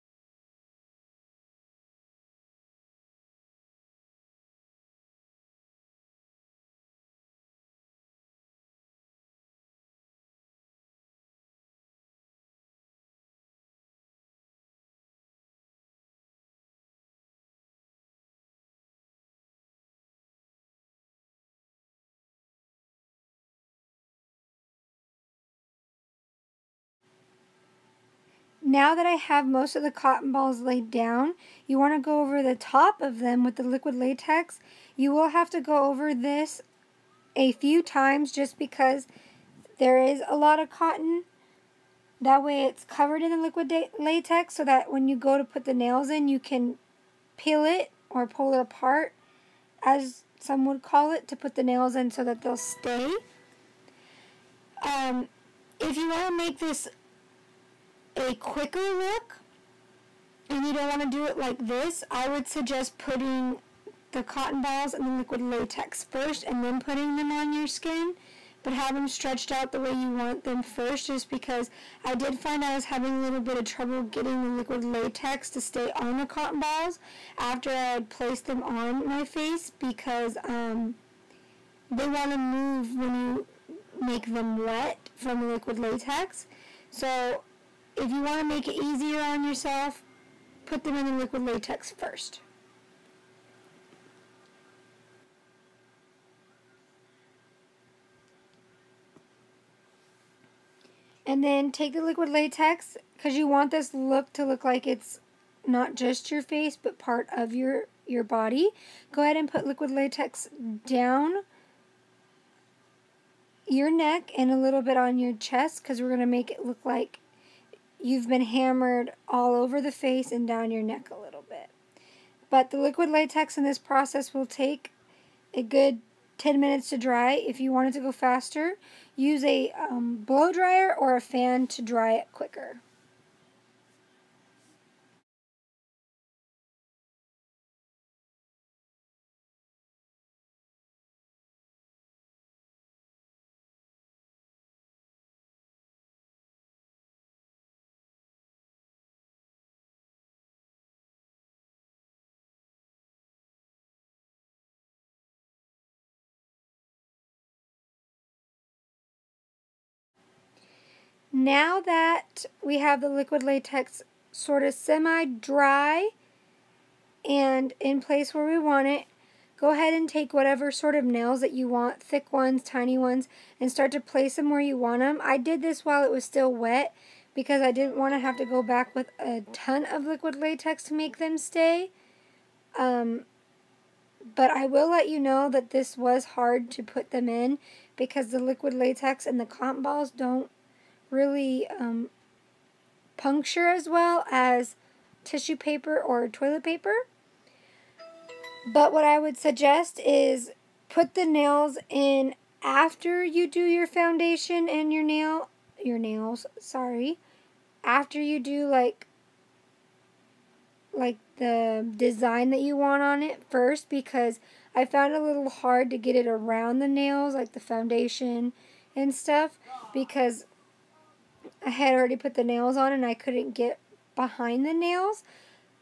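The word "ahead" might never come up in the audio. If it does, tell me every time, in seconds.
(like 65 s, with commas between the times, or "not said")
109 s, 169 s.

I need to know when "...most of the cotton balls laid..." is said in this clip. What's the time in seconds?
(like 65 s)
29 s.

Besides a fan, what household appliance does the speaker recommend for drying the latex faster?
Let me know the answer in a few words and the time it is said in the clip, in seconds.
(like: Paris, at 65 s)
blow dryer, at 130 s.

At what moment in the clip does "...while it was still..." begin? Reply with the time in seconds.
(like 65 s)
175 s.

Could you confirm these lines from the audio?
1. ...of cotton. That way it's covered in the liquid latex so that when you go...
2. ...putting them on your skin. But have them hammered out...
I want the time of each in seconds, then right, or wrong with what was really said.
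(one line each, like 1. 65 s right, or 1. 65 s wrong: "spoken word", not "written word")
1. 40 s right
2. 66 s wrong: "stretched", not "hammered".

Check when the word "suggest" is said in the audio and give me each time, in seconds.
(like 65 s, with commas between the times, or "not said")
62 s, 199 s.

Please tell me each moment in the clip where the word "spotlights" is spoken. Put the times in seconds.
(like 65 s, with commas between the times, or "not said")
not said.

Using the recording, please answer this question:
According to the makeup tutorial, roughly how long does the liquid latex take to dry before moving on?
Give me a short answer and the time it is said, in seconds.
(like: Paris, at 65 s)
10 minutes, at 126 s.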